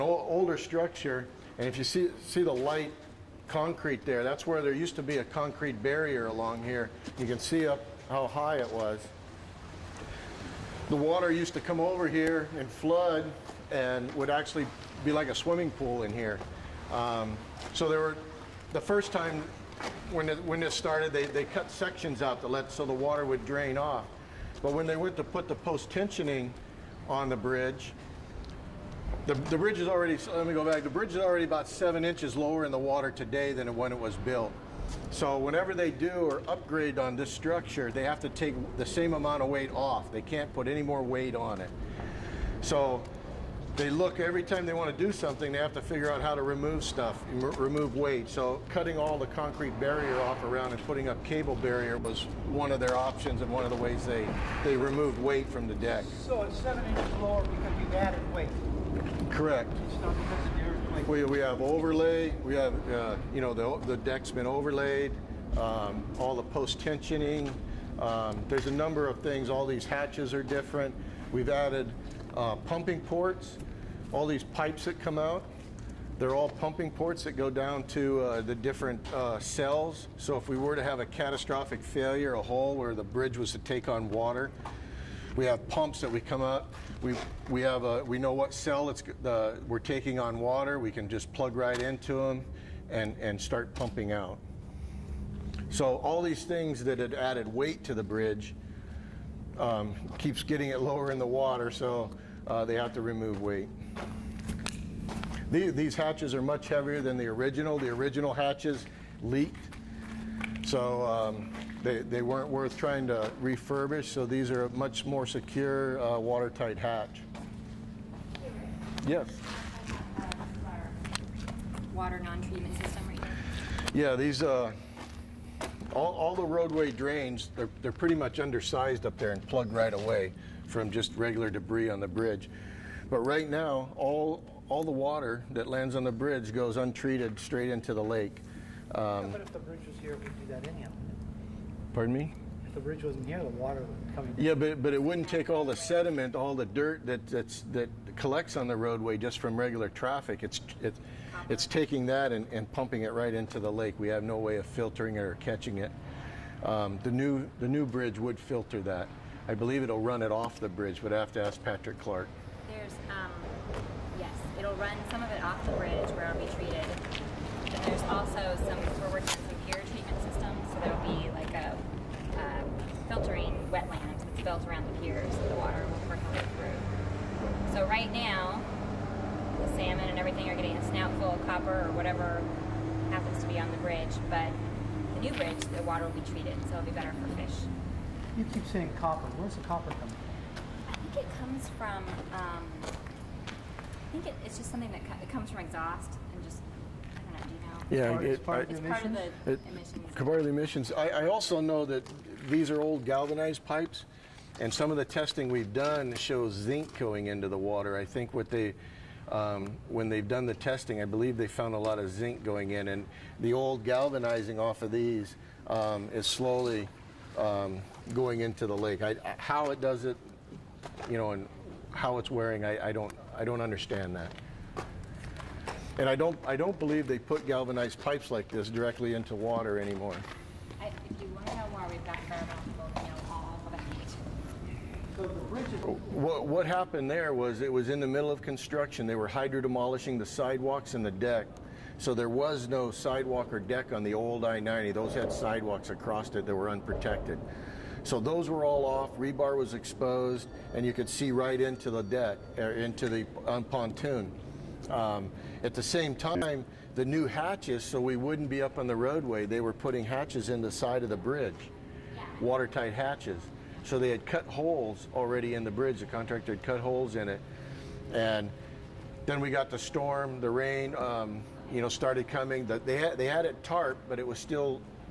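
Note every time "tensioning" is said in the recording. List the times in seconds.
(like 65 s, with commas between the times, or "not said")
25 s, 66 s.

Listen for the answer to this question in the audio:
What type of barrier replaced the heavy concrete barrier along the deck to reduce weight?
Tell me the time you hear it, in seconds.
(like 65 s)
51 s.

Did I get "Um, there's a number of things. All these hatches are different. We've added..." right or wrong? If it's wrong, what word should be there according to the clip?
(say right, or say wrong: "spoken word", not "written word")
right.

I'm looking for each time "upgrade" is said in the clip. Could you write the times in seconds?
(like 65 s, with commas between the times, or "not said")
36 s.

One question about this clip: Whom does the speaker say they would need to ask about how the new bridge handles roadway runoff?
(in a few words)
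Patrick Clark.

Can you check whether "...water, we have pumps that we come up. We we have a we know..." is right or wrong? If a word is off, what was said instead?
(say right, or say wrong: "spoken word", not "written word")
right.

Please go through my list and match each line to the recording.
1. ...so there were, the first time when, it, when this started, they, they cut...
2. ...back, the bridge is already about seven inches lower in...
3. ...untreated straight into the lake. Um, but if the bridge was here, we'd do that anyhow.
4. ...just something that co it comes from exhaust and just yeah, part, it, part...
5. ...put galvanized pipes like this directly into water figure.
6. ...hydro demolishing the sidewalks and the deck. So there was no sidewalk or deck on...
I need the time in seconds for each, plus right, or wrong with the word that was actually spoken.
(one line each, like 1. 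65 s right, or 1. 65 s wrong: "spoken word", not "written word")
1. 17 s right
2. 30 s right
3. 136 s right
4. 194 s right
5. 227 s wrong: "anymore", not "figure"
6. 239 s right.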